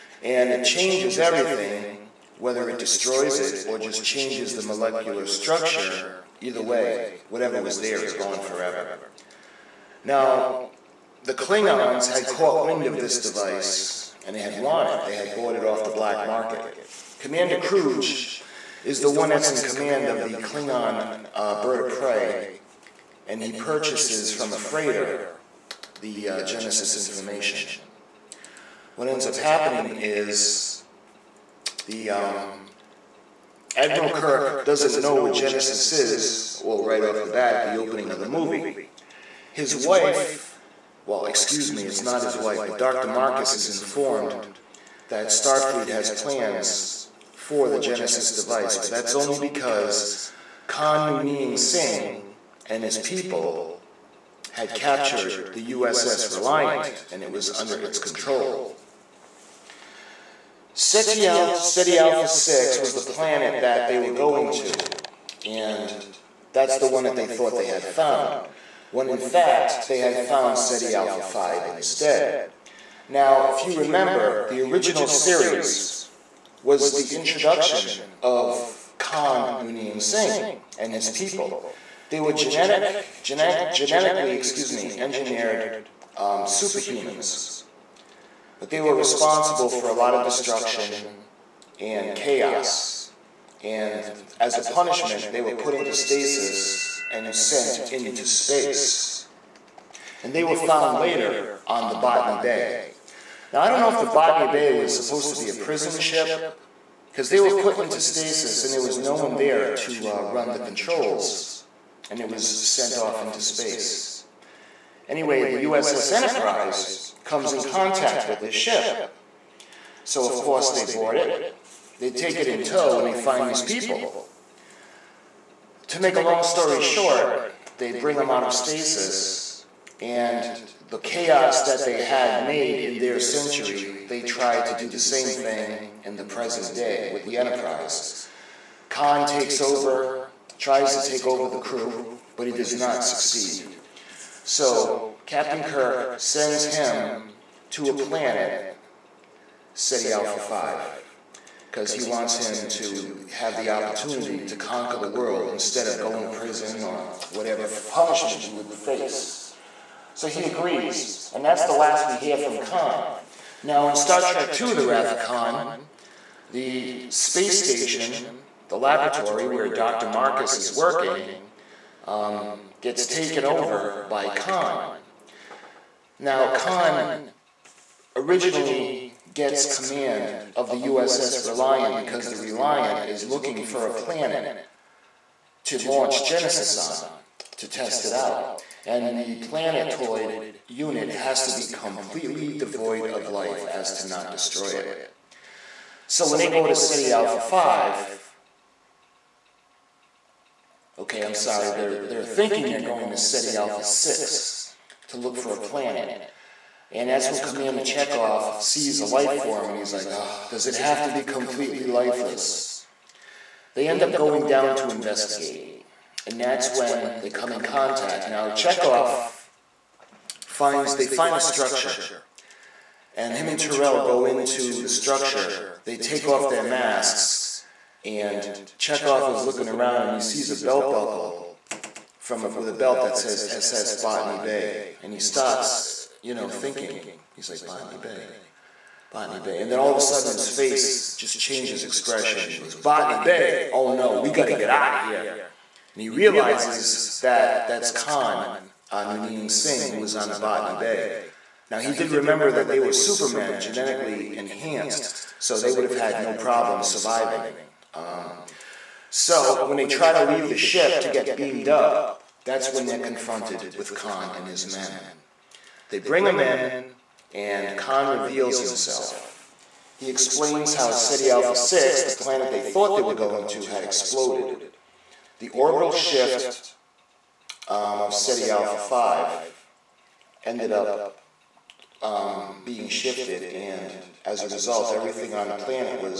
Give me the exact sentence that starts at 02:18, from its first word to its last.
Khan takes over, tries to take over the crew, but he does not succeed.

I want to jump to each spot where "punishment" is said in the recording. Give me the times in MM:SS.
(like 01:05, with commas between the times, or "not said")
01:34, 02:37.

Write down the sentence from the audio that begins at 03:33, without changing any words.
They end up going down to investigate.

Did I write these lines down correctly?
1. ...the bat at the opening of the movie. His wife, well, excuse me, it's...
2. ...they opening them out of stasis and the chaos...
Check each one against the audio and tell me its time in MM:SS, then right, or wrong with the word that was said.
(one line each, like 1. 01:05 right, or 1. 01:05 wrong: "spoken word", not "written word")
1. 00:37 right
2. 02:07 wrong: "bring", not "opening".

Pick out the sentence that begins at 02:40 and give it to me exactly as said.
So he agrees, and that's the last we hear from Khan.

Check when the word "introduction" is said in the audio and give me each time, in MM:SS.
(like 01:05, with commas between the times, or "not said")
01:17.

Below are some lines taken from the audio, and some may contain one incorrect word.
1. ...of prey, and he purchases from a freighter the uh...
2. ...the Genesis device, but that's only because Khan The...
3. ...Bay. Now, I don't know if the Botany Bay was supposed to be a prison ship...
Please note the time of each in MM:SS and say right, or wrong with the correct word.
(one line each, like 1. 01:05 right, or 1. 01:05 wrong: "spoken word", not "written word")
1. 00:21 right
2. 00:47 wrong: "Noonien", not "The"
3. 01:42 right.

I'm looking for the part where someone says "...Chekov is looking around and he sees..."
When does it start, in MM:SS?
03:48.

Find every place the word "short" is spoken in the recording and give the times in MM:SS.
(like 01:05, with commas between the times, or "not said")
02:06.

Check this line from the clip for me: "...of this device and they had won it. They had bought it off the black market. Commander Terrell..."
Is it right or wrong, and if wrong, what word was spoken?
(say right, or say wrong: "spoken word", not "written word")
wrong: "Kruge", not "Terrell".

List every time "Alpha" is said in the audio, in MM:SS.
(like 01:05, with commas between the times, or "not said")
01:01, 01:10, 02:30, 03:17, 03:23, 04:31, 04:38.